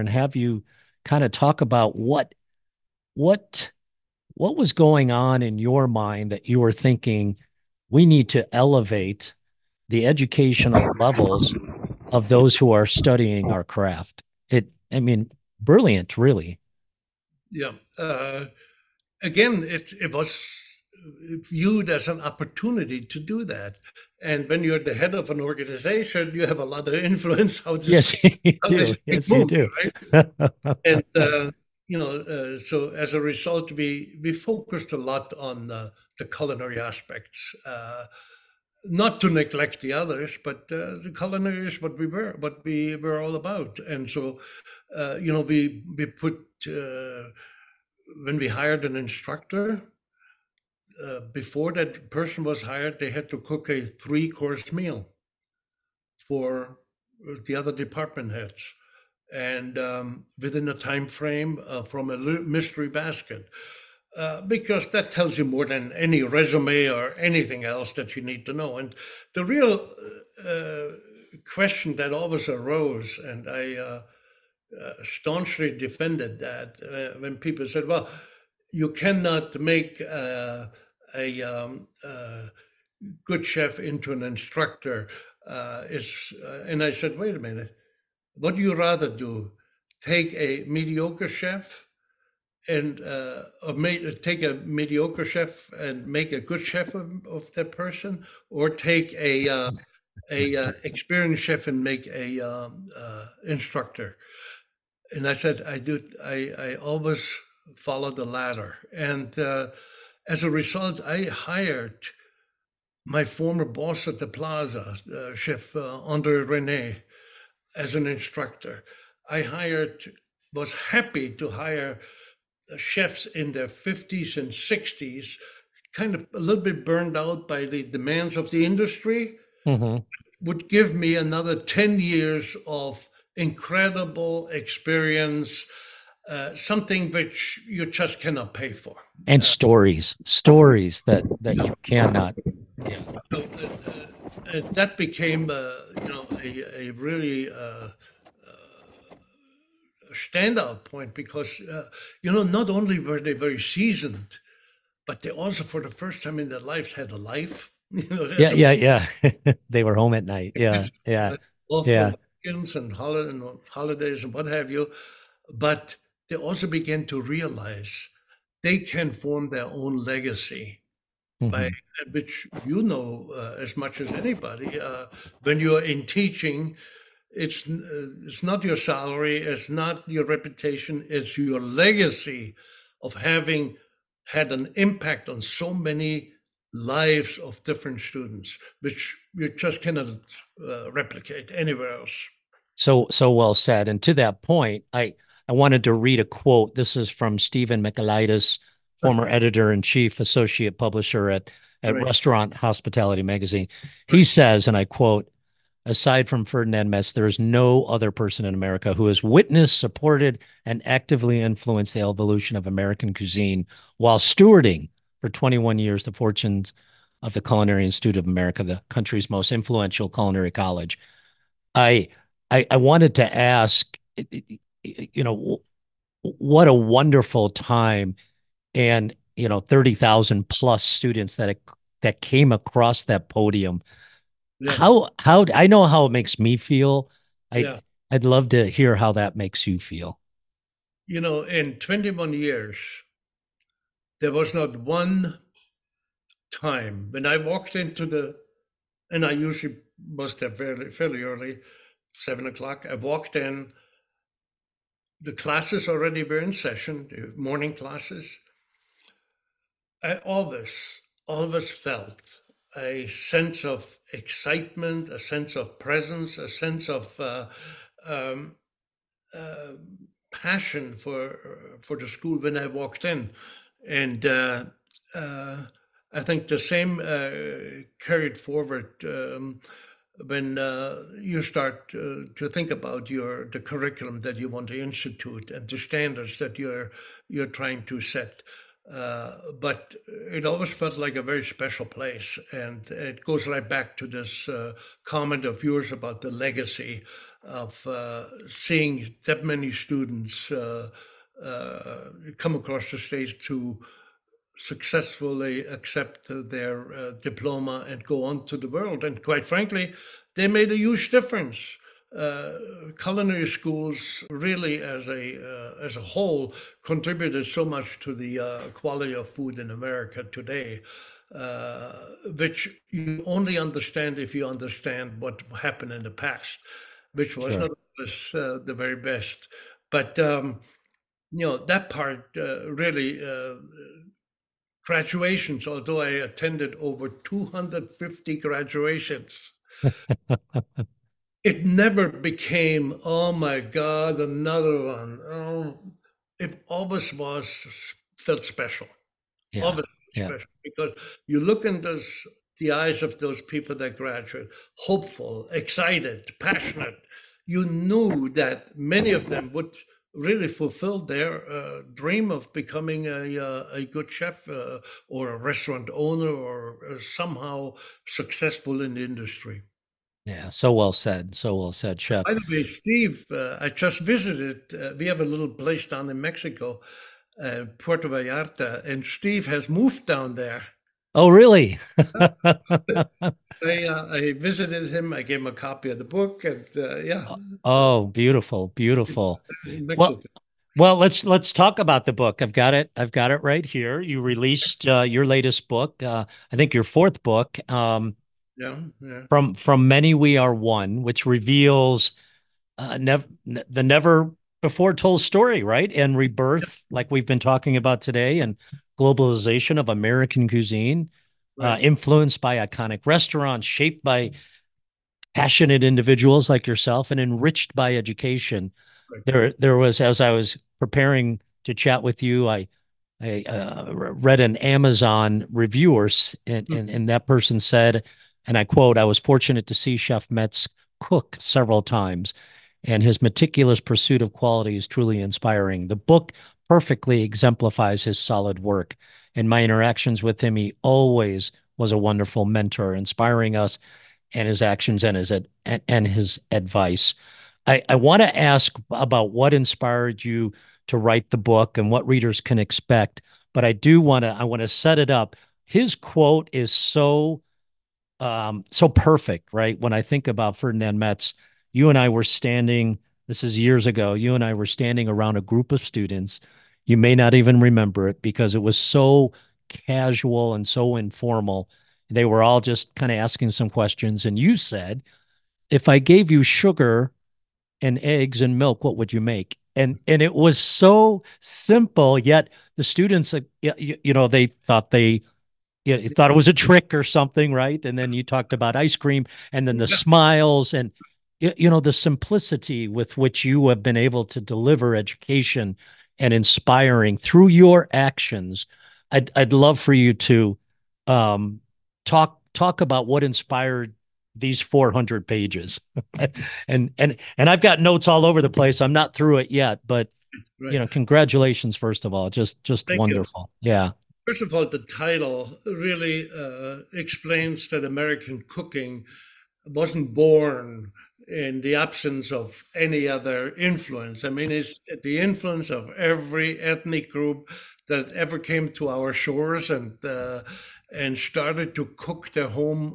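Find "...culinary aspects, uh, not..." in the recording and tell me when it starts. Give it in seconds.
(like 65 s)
36 s.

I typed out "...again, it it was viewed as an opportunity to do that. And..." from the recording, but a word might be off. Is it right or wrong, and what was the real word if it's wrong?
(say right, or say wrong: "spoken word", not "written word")
right.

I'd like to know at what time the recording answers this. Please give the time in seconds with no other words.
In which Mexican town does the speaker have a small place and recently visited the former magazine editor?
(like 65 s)
377 s.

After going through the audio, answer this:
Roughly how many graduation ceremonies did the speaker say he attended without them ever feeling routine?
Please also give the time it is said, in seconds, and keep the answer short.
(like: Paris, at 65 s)
over 250, at 336 s.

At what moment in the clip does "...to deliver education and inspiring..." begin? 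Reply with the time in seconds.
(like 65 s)
494 s.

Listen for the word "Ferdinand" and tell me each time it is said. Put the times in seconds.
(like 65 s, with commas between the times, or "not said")
206 s, 460 s.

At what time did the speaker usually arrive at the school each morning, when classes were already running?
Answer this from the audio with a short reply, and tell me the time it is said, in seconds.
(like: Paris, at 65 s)
7:00, at 252 s.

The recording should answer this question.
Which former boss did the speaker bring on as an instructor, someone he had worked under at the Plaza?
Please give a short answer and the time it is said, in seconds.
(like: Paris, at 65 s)
Andre Rene, at 115 s.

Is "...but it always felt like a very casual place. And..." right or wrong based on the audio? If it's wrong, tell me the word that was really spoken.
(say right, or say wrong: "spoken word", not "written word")
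wrong: "special", not "casual".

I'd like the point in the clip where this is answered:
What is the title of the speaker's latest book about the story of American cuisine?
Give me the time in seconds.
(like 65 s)
399 s.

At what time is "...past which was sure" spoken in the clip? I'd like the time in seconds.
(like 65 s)
326 s.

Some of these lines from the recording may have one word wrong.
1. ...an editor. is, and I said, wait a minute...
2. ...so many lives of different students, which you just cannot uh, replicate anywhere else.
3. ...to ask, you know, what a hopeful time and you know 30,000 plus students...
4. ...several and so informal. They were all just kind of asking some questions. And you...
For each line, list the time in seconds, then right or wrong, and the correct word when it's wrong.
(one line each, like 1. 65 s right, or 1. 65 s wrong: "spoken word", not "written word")
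1. 84 s wrong: "instructor", not "editor"
2. 185 s right
3. 223 s wrong: "wonderful", not "hopeful"
4. 469 s wrong: "casual", not "several".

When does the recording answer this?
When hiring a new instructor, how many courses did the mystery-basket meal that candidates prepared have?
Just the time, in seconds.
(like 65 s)
54 s.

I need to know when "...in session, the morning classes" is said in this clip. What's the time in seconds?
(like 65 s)
256 s.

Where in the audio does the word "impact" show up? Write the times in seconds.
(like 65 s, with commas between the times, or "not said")
184 s.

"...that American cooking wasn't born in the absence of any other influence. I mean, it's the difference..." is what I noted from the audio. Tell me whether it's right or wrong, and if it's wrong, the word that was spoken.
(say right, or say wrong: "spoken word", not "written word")
wrong: "influence", not "difference".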